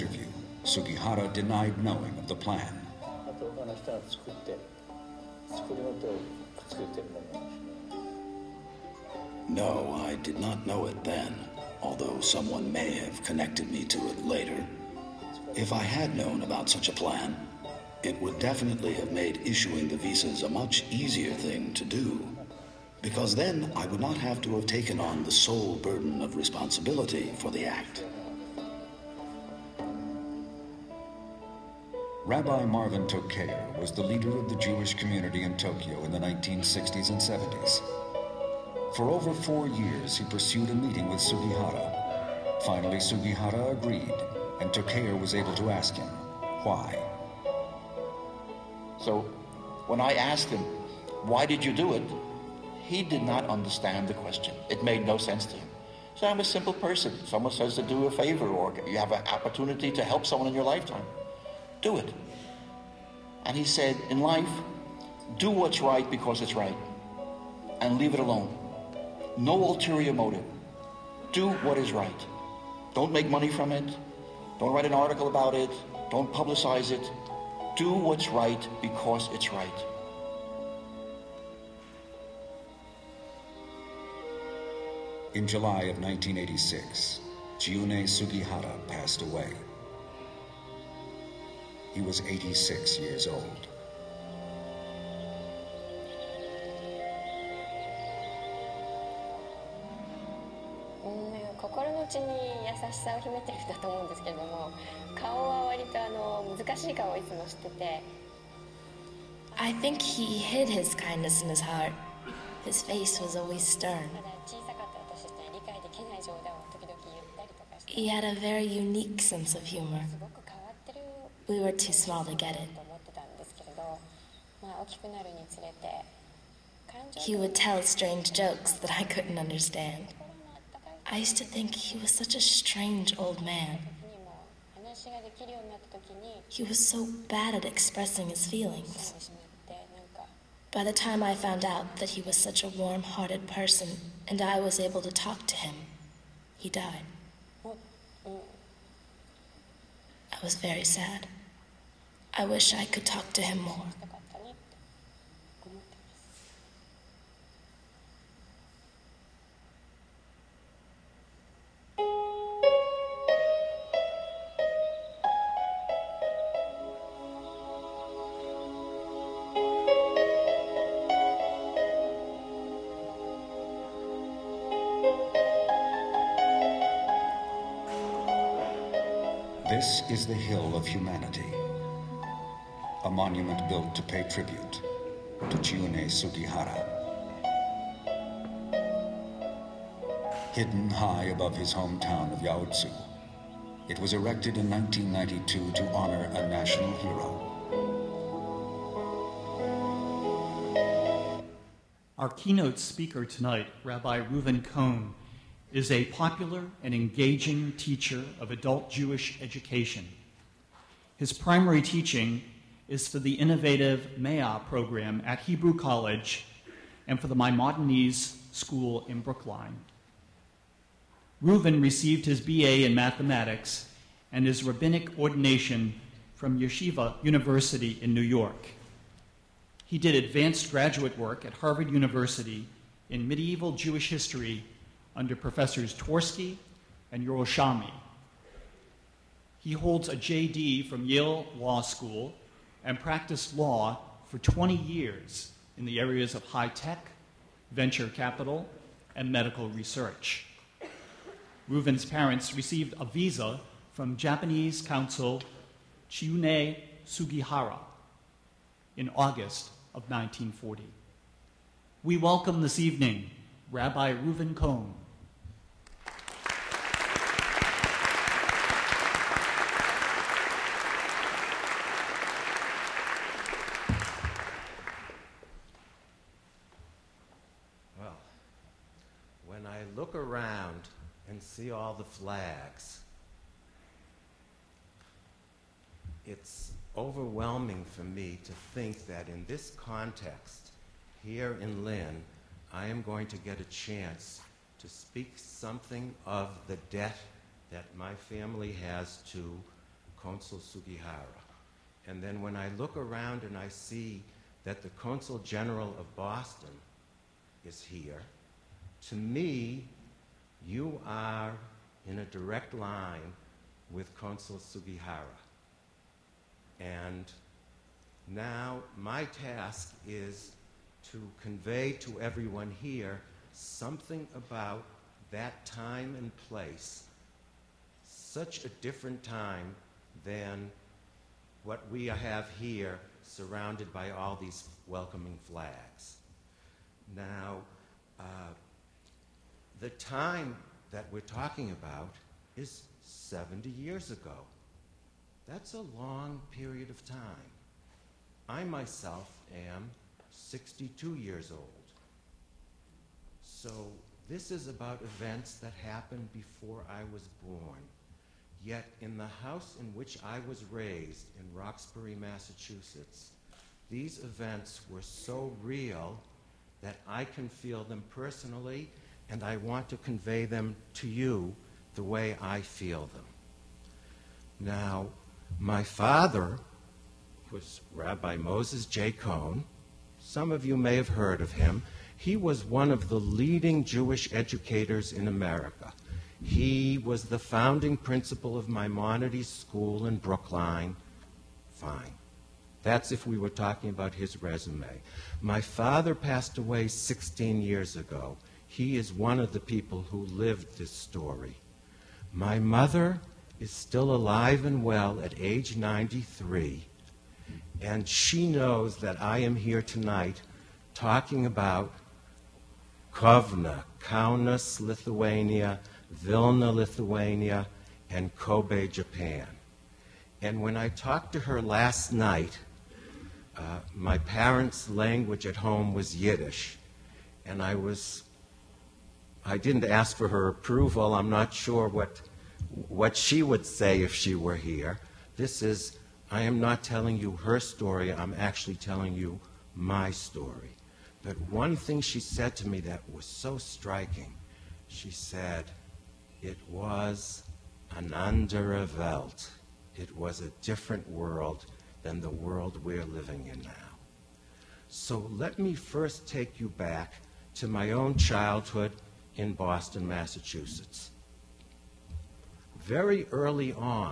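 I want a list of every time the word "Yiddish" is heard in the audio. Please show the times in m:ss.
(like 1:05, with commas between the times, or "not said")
7:06.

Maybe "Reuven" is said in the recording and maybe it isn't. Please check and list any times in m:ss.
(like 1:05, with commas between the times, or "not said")
3:24, 3:41, 4:11, 4:24.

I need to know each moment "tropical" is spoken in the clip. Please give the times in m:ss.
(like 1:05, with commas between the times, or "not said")
not said.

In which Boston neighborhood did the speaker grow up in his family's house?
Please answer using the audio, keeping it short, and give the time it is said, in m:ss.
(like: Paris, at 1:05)
Roxbury, at 6:01.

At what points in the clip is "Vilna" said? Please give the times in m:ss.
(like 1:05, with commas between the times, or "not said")
6:56.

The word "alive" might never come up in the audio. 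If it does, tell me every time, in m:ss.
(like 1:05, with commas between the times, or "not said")
6:44.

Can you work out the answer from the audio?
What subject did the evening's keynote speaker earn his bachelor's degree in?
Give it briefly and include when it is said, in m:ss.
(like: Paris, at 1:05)
Mathematics, at 3:42.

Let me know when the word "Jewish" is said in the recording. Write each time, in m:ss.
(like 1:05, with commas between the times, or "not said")
0:34, 3:28, 3:53, 6:23.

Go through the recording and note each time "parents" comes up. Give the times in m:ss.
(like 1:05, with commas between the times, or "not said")
4:12, 7:04.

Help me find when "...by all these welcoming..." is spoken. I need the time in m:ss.
5:33.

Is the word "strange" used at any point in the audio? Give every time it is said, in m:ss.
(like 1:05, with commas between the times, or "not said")
2:07, 2:12.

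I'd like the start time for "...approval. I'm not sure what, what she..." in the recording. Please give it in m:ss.
7:10.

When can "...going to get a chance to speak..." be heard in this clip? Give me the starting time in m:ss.
4:53.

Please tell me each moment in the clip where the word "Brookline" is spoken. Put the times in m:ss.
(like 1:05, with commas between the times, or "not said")
3:39, 6:30.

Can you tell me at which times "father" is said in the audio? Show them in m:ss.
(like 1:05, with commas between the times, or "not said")
6:15, 6:35.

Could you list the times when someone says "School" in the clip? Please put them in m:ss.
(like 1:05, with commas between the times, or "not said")
3:38, 4:01, 6:29.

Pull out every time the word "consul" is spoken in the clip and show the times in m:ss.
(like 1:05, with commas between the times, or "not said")
4:14, 5:00, 5:04, 5:14.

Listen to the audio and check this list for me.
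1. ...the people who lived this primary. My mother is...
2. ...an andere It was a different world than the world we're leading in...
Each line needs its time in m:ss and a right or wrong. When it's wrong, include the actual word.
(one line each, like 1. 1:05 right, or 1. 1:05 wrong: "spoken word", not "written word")
1. 6:39 wrong: "story", not "primary"
2. 7:27 wrong: "living", not "leading".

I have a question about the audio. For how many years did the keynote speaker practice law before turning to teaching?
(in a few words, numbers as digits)
20.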